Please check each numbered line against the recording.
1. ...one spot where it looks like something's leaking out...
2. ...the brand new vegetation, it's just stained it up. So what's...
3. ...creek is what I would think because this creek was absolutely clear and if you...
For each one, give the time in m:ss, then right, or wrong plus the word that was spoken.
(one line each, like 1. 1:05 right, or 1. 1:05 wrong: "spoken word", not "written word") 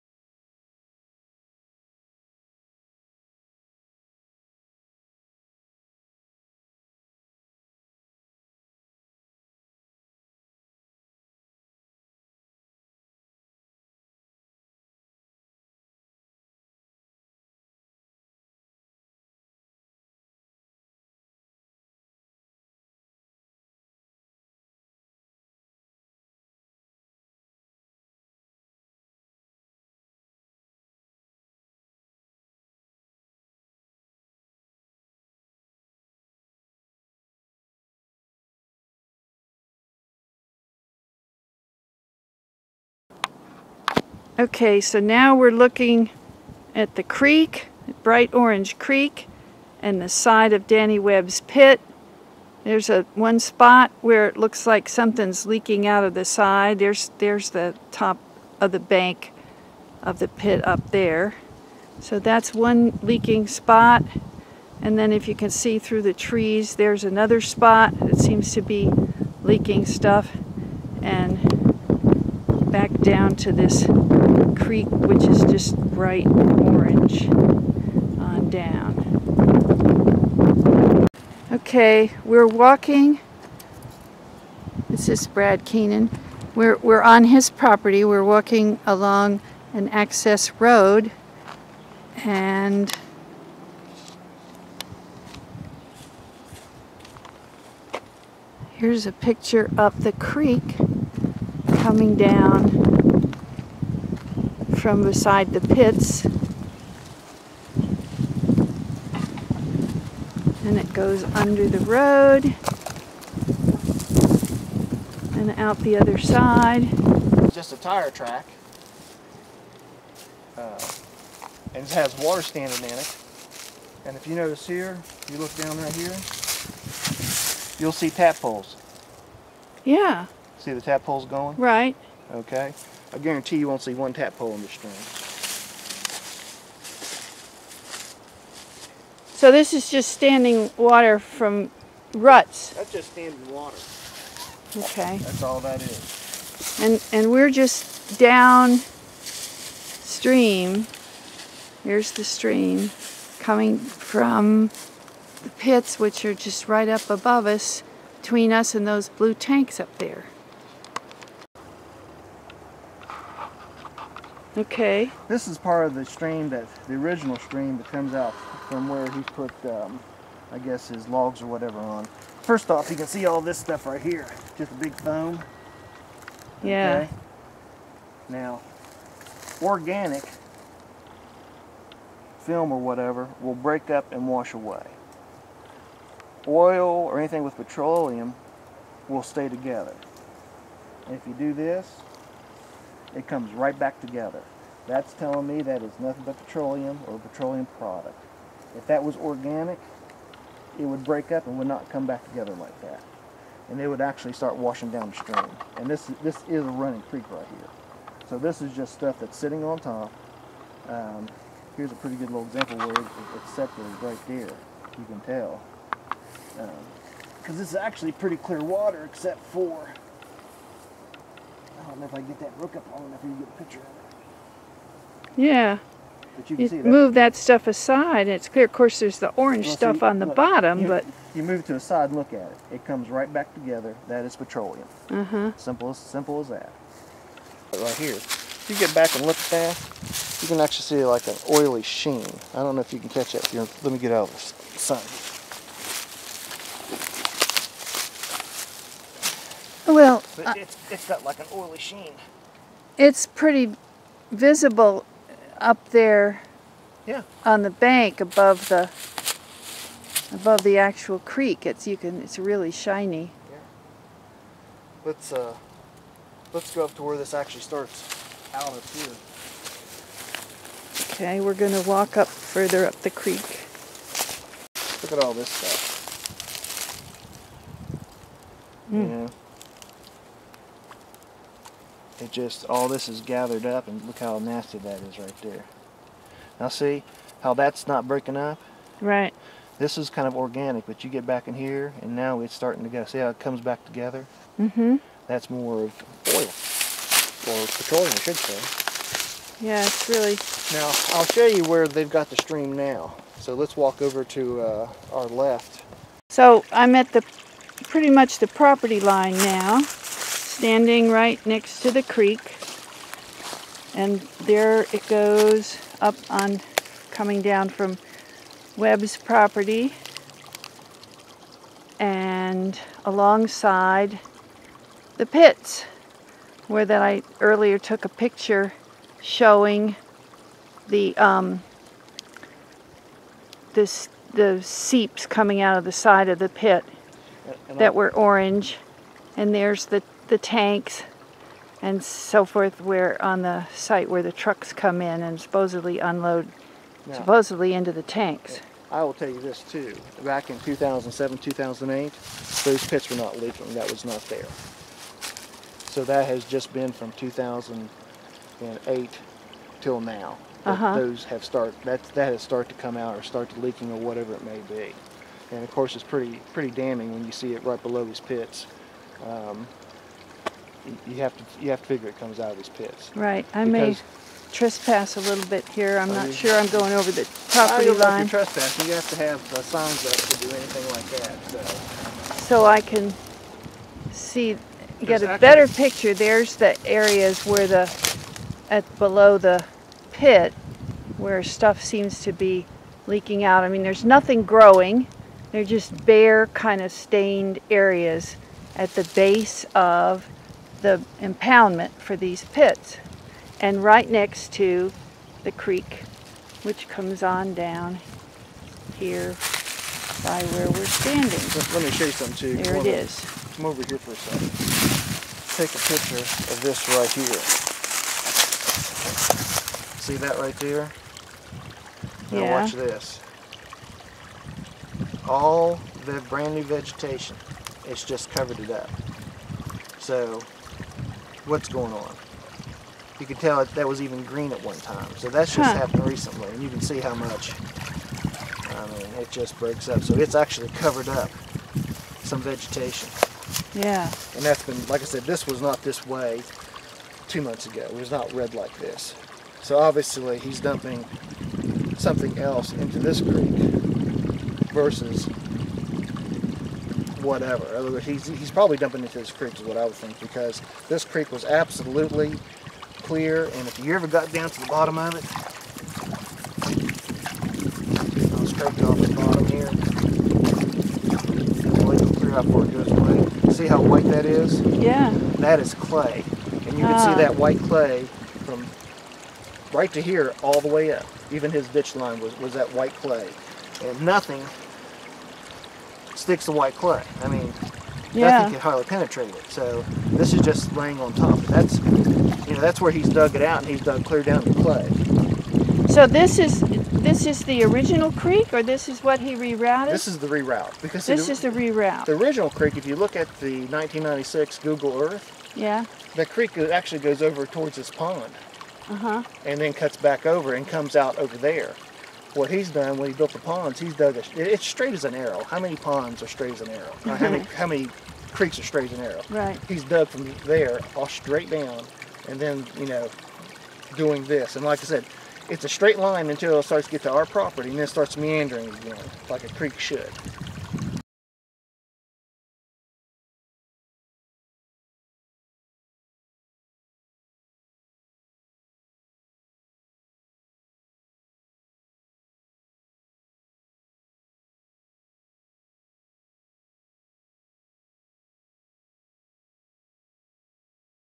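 1. 0:53 right
2. 7:06 wrong: "covered", not "stained"
3. 7:39 right.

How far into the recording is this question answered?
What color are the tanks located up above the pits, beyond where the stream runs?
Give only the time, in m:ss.
2:39.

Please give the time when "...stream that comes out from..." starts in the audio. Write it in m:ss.
2:47.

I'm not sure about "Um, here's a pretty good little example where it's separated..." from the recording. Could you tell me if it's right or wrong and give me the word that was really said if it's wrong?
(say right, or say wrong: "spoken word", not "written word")
right.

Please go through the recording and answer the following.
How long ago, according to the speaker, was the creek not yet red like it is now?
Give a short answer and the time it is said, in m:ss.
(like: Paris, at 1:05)
Two months, at 7:27.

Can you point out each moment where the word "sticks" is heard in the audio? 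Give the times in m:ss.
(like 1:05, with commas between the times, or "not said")
8:06.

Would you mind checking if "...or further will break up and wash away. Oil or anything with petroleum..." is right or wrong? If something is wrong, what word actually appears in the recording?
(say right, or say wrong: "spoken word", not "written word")
wrong: "whatever", not "further".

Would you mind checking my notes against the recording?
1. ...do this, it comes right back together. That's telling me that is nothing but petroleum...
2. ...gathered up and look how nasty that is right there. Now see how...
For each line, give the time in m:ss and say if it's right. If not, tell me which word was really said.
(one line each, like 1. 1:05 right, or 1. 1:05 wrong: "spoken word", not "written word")
1. 3:11 right
2. 4:43 right.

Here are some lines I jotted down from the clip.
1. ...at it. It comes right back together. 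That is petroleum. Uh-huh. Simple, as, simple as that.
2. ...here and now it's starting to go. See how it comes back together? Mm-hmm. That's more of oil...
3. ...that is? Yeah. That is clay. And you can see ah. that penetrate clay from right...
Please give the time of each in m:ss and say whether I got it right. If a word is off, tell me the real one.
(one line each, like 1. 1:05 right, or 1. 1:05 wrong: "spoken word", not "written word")
1. 3:52 right
2. 4:51 right
3. 7:54 wrong: "white", not "penetrate".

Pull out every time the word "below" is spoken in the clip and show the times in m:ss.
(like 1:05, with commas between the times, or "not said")
6:07, 6:28.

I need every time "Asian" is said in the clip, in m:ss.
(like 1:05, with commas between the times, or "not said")
not said.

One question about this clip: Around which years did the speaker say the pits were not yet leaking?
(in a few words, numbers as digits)
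2007, 2008.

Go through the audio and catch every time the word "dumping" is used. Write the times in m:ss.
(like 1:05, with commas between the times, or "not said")
7:30, 7:38.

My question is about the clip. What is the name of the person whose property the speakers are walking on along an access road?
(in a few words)
Brad Keenan.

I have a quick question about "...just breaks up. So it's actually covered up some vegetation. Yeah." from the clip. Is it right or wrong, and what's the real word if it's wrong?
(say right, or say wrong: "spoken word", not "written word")
right.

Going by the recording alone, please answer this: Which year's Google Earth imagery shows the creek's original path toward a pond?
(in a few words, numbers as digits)
1996.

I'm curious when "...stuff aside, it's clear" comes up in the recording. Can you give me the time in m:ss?
3:47.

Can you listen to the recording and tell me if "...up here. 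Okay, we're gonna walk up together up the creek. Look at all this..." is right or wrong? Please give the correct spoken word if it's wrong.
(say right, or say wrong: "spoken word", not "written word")
wrong: "further", not "together".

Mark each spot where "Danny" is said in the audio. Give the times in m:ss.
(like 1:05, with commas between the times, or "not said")
0:50.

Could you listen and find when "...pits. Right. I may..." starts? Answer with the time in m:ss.
6:12.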